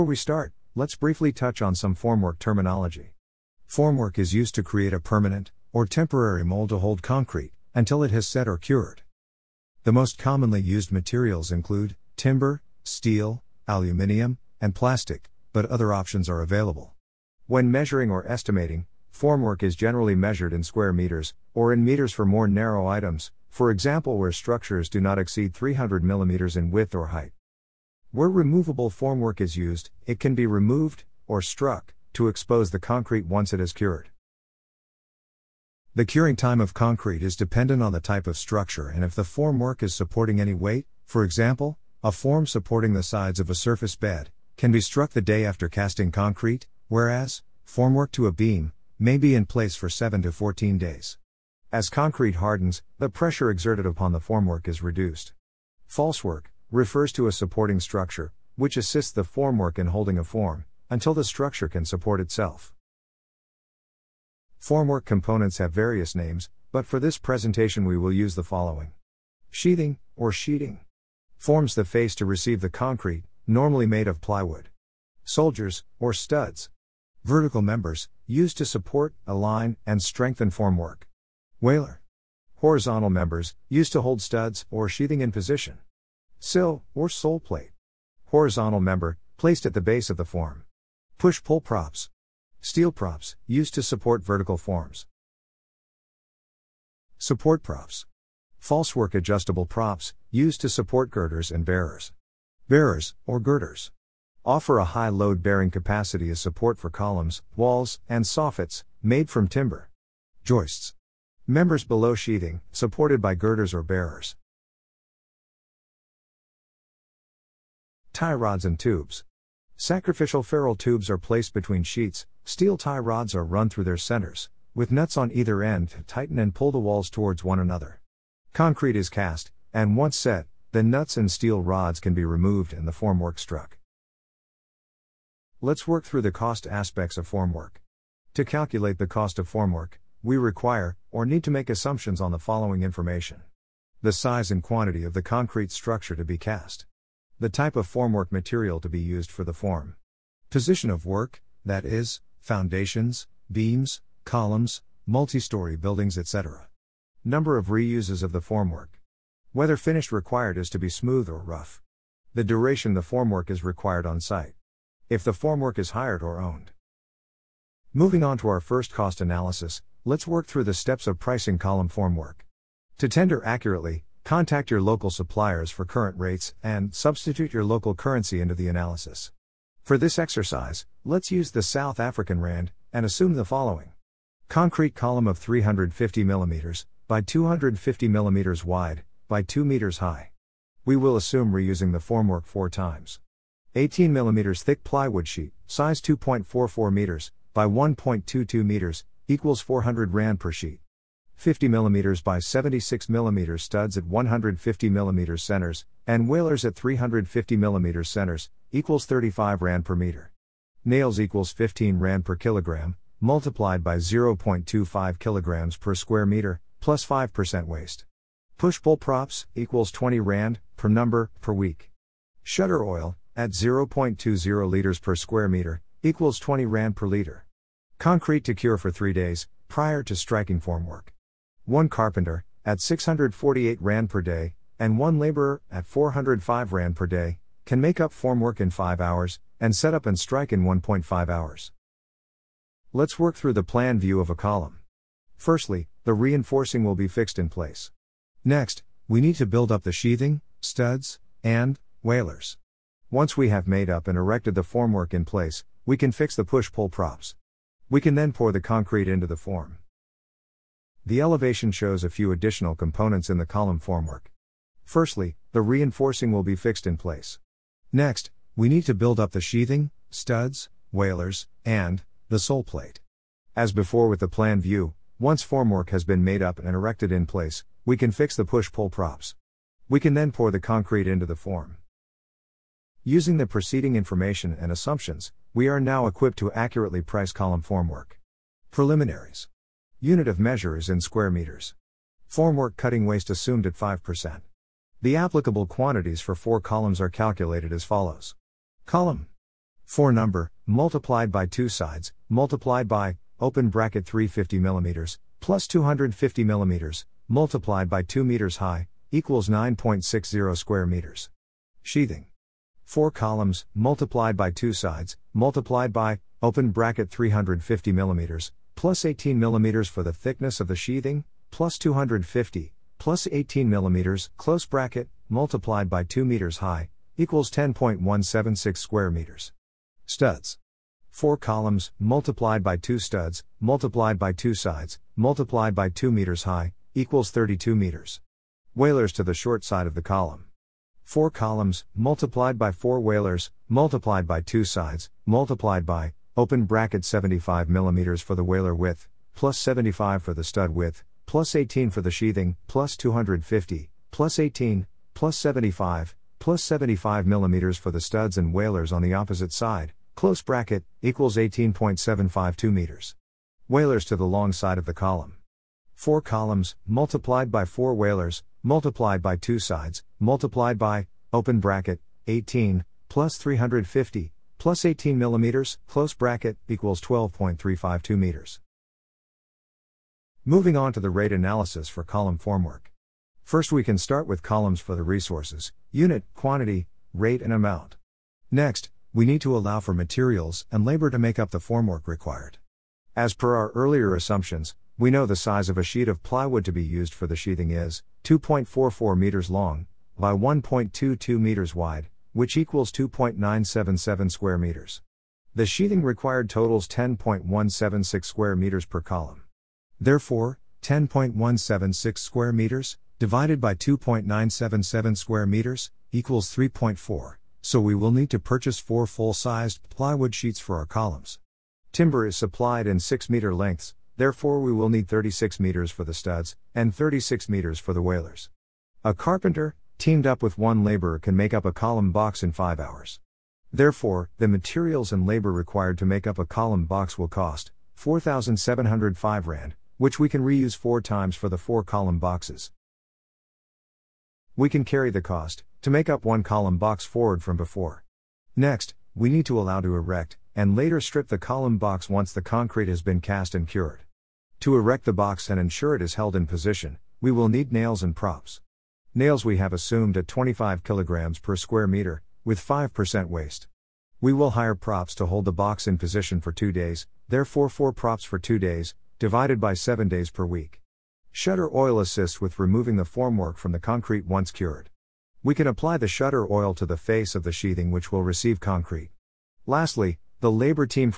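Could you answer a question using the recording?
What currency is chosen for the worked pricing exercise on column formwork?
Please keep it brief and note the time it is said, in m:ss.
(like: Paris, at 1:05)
South African Rand, at 3:01.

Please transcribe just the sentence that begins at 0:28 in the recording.
Where removable formwork is used, it can be removed, or struck, to expose the concrete once it is cured.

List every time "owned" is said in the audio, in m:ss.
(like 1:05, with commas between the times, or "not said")
2:46.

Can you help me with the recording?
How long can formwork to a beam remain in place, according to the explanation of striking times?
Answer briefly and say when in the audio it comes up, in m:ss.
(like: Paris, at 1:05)
7 to 14 days, at 0:49.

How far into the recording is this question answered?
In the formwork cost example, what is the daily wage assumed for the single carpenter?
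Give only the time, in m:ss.
3:52.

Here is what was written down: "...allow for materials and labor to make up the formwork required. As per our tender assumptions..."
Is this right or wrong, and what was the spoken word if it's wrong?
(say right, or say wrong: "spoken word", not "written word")
wrong: "earlier", not "tender".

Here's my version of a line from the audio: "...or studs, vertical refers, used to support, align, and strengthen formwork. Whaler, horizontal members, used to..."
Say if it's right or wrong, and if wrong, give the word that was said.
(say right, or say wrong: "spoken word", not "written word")
wrong: "members", not "refers".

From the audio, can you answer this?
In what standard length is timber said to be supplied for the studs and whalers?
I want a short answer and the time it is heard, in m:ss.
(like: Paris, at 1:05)
6 meters, at 7:02.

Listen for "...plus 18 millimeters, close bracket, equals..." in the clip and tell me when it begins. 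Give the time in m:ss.
6:14.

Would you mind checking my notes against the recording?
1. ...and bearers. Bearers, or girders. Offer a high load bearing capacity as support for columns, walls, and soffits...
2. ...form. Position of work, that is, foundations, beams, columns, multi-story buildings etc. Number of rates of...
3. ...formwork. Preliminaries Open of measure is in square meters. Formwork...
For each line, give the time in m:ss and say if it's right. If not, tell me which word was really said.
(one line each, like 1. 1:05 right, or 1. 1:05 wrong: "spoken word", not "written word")
1. 1:41 right
2. 2:29 wrong: "reuses", not "rates"
3. 4:47 wrong: "Unit", not "Open".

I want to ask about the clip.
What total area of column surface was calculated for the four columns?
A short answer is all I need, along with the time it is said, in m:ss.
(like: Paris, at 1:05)
9.60 square meters, at 5:09.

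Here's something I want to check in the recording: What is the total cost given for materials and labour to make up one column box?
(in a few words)
4,705 Rand.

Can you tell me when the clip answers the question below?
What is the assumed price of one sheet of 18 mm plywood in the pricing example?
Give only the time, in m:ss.
3:19.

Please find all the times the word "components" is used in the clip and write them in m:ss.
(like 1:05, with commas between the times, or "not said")
1:05, 4:22.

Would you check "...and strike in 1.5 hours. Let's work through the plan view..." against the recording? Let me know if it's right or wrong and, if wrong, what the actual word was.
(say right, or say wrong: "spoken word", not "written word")
right.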